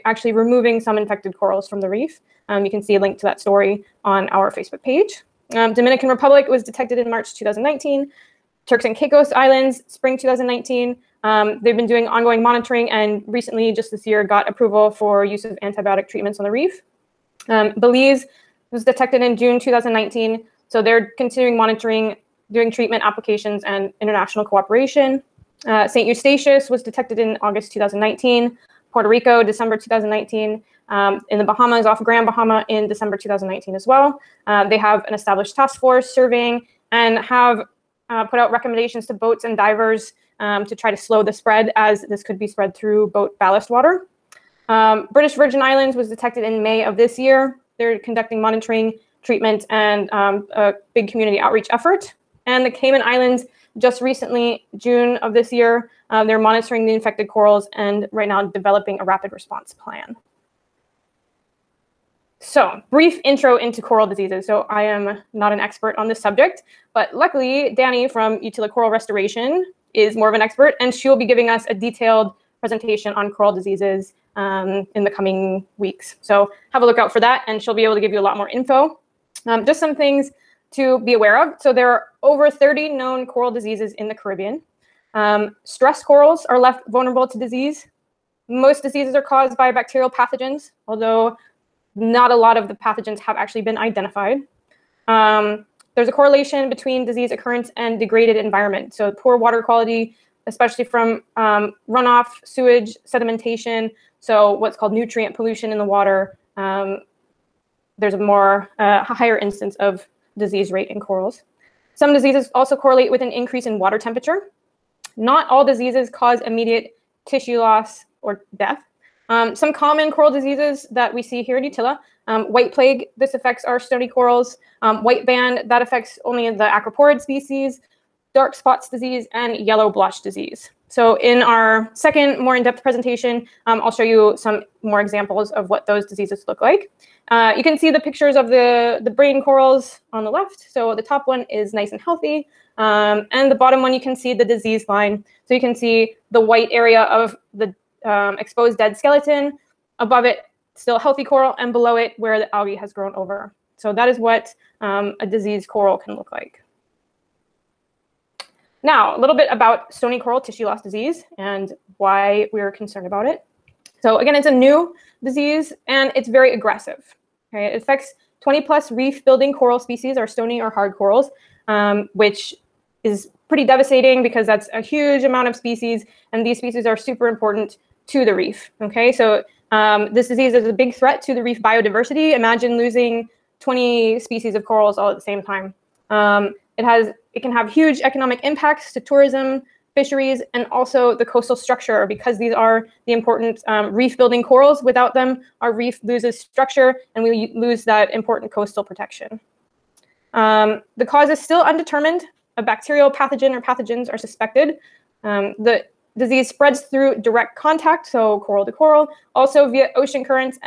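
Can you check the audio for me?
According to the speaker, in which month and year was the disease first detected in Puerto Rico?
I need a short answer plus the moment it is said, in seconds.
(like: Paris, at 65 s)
December 2019, at 28 s.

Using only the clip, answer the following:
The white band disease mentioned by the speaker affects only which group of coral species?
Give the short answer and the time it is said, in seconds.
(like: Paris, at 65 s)
acroporid species, at 126 s.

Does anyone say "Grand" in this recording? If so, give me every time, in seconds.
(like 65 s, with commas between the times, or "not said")
32 s.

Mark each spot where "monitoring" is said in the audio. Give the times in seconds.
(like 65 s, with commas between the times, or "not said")
12 s, 21 s, 48 s, 56 s.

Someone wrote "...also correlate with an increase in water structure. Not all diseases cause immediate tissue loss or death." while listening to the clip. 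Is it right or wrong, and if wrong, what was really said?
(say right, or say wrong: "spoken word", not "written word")
wrong: "temperature", not "structure".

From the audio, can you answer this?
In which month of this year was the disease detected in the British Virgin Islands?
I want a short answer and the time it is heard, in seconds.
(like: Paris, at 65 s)
May, at 46 s.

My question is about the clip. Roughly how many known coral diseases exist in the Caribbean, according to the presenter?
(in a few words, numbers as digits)
over 30.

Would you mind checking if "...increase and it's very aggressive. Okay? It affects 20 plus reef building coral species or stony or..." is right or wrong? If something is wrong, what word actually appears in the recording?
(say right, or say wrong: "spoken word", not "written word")
wrong: "disease", not "increase".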